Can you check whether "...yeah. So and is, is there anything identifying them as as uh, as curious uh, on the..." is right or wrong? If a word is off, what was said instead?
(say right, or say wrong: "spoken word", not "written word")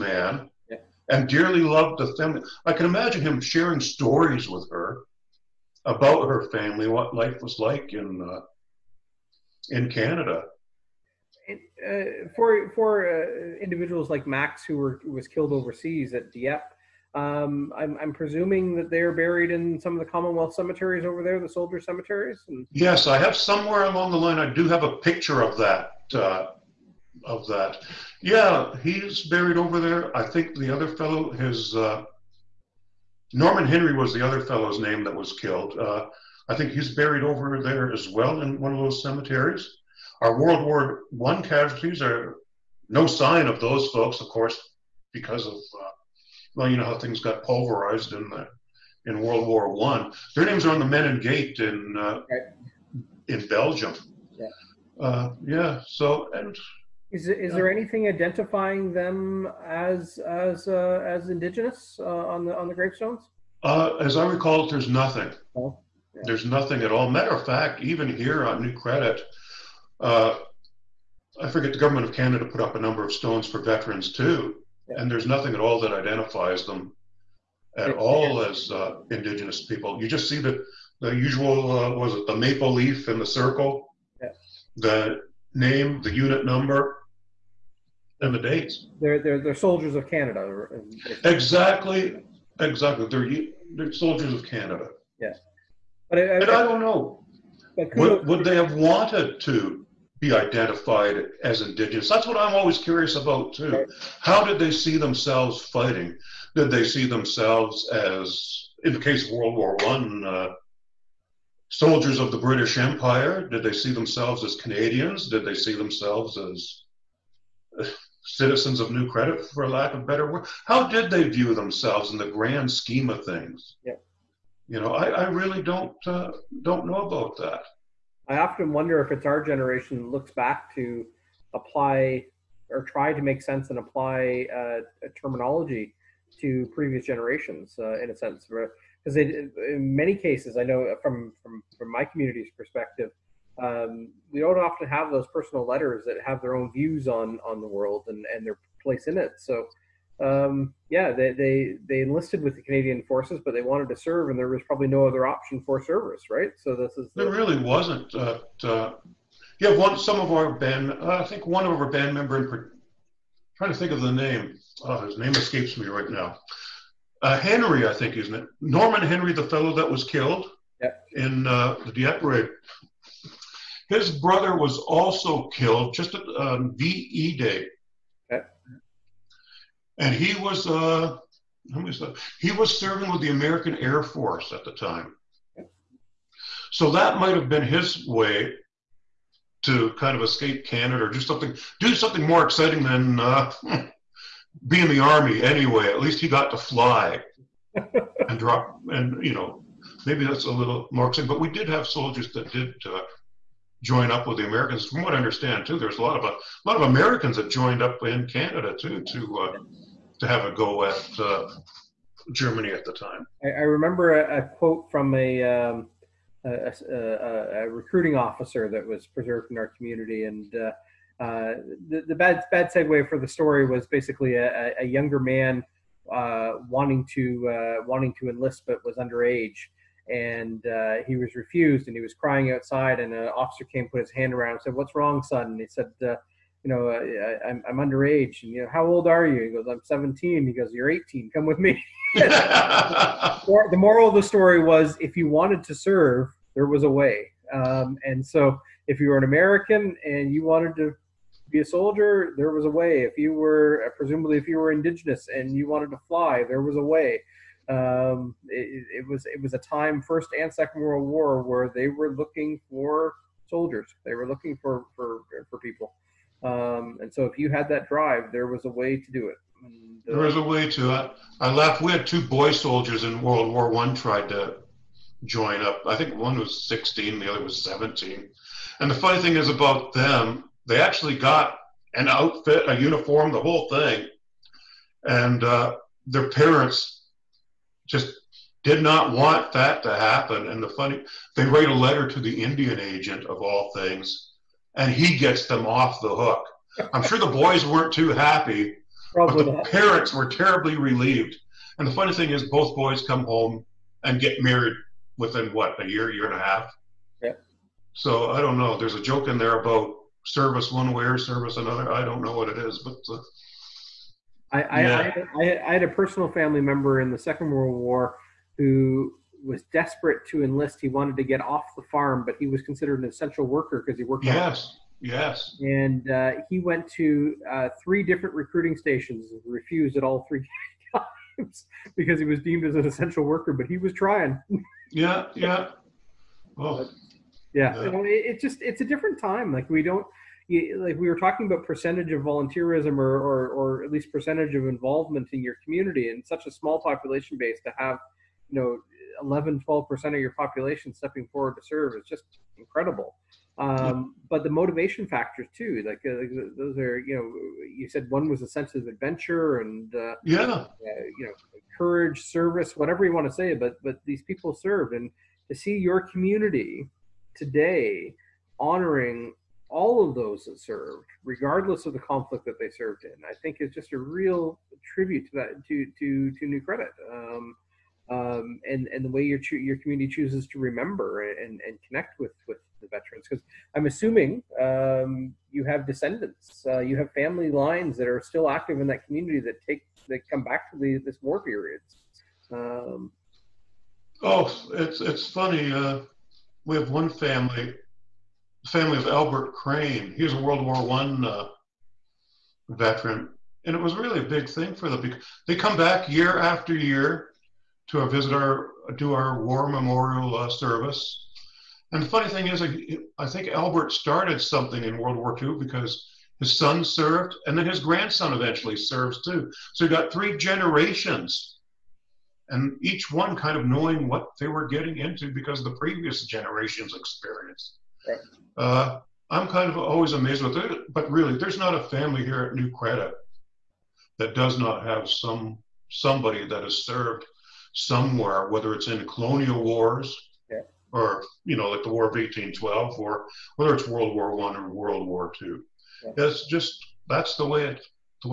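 wrong: "indigenous", not "curious".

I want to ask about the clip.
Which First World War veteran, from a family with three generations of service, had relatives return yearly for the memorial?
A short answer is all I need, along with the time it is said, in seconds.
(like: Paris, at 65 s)
Albert Crane, at 399 s.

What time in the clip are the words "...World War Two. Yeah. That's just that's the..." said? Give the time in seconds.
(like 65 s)
444 s.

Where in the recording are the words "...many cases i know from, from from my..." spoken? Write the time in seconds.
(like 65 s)
139 s.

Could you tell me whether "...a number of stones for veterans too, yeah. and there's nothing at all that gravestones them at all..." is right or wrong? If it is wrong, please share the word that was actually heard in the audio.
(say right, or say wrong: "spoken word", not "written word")
wrong: "identifies", not "gravestones".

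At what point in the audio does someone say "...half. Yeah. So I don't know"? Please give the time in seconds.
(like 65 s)
306 s.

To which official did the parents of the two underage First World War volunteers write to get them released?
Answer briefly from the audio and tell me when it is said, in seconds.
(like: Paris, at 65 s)
Indian agent, at 292 s.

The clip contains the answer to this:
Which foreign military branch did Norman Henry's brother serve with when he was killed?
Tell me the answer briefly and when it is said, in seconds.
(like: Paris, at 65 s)
American Air Force, at 183 s.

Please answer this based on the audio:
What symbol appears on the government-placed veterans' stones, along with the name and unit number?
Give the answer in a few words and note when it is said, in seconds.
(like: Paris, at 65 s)
maple leaf in the circle, at 82 s.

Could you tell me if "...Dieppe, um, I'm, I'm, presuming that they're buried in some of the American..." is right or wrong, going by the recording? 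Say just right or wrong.
wrong.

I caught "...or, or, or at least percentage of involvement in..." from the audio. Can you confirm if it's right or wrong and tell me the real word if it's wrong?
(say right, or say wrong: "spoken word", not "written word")
right.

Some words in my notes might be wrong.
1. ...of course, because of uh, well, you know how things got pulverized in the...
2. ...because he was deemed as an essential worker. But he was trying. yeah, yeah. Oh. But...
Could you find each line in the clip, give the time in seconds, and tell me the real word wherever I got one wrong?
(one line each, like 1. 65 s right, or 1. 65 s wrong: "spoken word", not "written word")
1. 44 s right
2. 331 s right.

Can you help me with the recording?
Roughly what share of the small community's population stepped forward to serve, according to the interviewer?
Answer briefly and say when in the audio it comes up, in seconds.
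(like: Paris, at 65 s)
11-12%, at 349 s.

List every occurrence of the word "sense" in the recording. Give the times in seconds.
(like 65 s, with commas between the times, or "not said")
133 s, 138 s, 358 s.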